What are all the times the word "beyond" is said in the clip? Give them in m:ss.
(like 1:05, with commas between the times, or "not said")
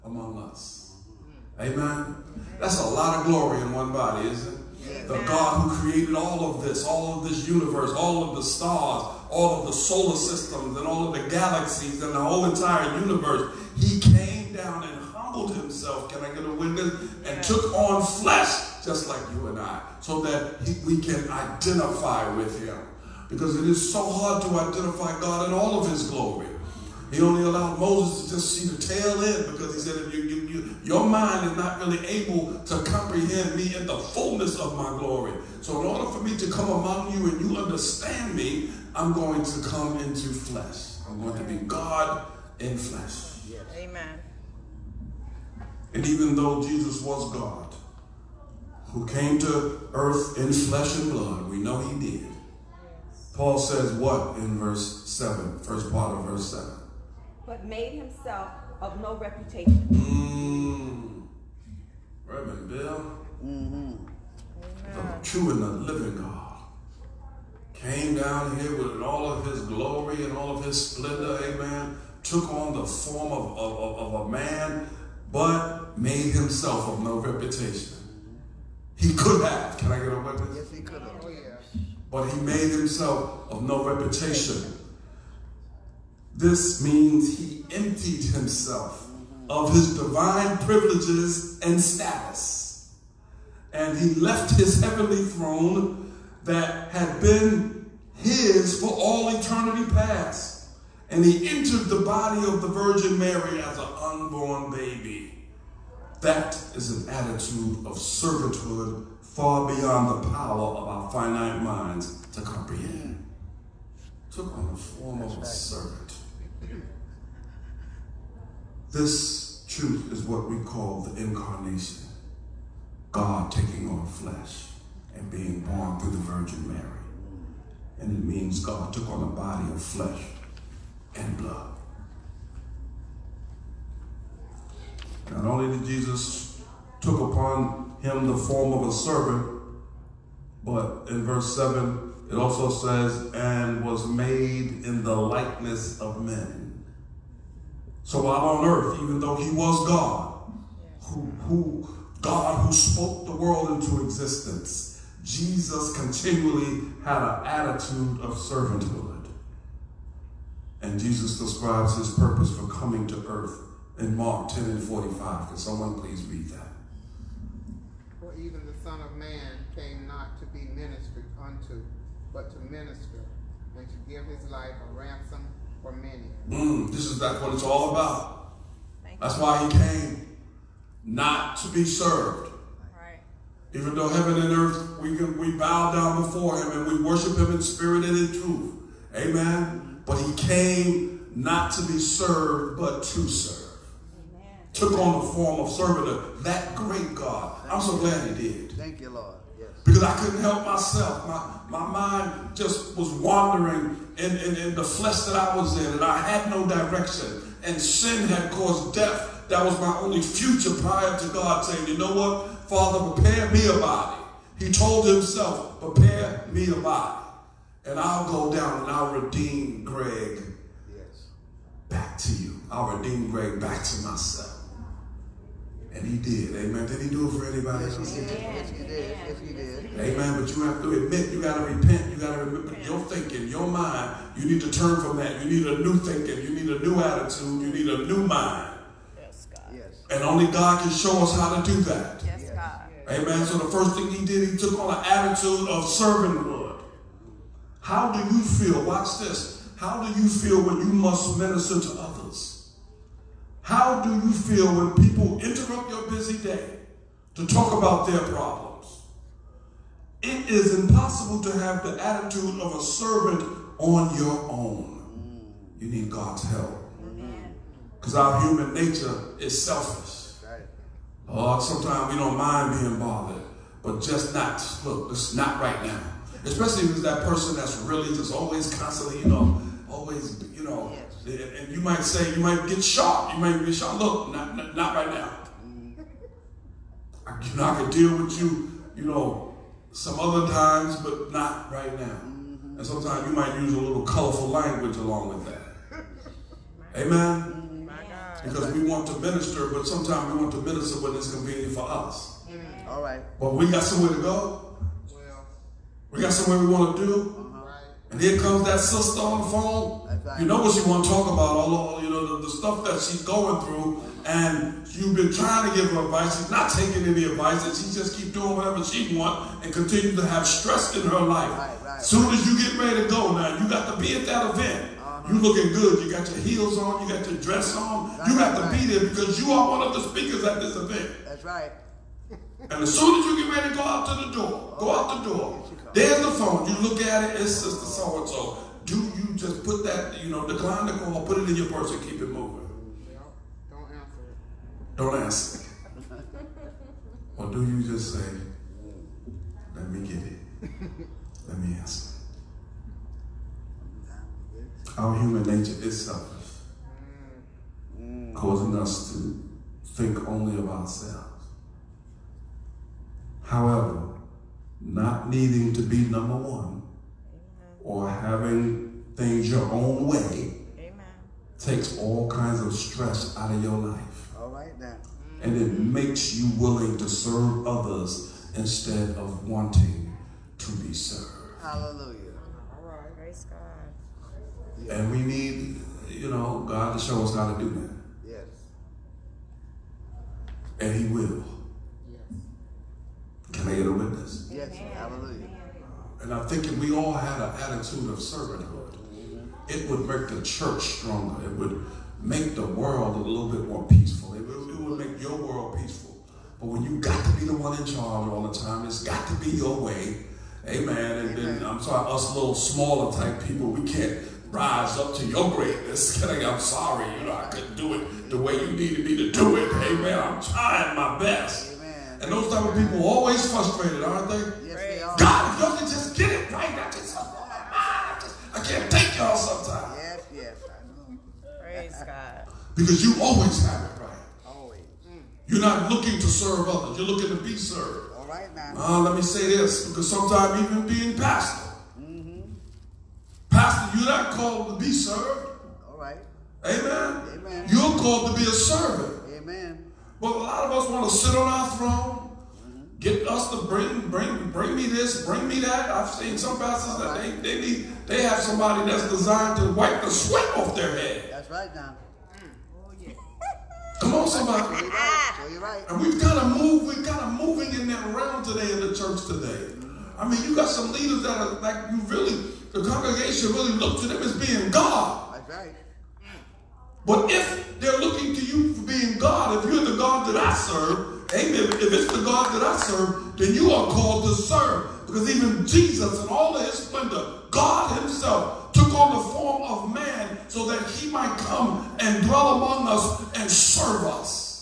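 1:49.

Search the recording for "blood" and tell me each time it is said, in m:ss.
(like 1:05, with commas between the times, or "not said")
0:51, 2:11.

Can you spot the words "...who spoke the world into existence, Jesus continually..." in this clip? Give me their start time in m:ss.
2:32.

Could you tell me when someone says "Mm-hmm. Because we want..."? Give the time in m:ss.
4:57.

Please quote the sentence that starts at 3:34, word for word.
He told himself, Prepare me a body, and I'll go down and I'll redeem Gregg yes.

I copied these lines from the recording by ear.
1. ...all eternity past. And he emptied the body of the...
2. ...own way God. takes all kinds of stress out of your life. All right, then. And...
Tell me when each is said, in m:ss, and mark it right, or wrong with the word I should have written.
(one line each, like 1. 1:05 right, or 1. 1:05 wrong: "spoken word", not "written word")
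1. 1:38 wrong: "entered", not "emptied"
2. 6:09 wrong: "Amen", not "God".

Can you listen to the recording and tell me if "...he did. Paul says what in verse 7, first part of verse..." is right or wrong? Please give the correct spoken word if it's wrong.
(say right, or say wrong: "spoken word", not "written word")
right.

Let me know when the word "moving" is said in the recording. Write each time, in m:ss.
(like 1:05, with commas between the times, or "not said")
5:42, 7:47.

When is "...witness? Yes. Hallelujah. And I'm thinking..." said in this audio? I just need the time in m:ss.
6:33.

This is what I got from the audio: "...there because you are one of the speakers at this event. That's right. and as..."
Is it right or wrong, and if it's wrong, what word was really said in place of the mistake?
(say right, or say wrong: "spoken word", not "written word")
right.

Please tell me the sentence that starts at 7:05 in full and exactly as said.
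God, if y'all can just get it right, I just oh, my I just I can't take y'all sometimes.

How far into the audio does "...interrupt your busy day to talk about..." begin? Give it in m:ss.
4:15.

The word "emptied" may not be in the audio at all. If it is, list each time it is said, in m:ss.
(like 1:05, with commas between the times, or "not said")
1:27.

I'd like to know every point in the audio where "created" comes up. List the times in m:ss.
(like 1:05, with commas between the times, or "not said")
0:05.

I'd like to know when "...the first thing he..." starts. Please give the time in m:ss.
4:03.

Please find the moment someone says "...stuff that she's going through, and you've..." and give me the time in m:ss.
5:12.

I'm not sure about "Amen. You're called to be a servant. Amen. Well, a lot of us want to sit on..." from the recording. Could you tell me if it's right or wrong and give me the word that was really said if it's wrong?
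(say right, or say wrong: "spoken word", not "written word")
right.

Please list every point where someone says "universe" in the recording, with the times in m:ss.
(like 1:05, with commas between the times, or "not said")
0:07, 0:13.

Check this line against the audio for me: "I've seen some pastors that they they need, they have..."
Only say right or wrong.
right.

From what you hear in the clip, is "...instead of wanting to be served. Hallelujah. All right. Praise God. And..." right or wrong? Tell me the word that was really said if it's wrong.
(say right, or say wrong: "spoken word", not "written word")
right.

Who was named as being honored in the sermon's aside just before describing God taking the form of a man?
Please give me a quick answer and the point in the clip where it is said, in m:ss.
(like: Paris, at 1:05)
Reverend Bill, at 1:02.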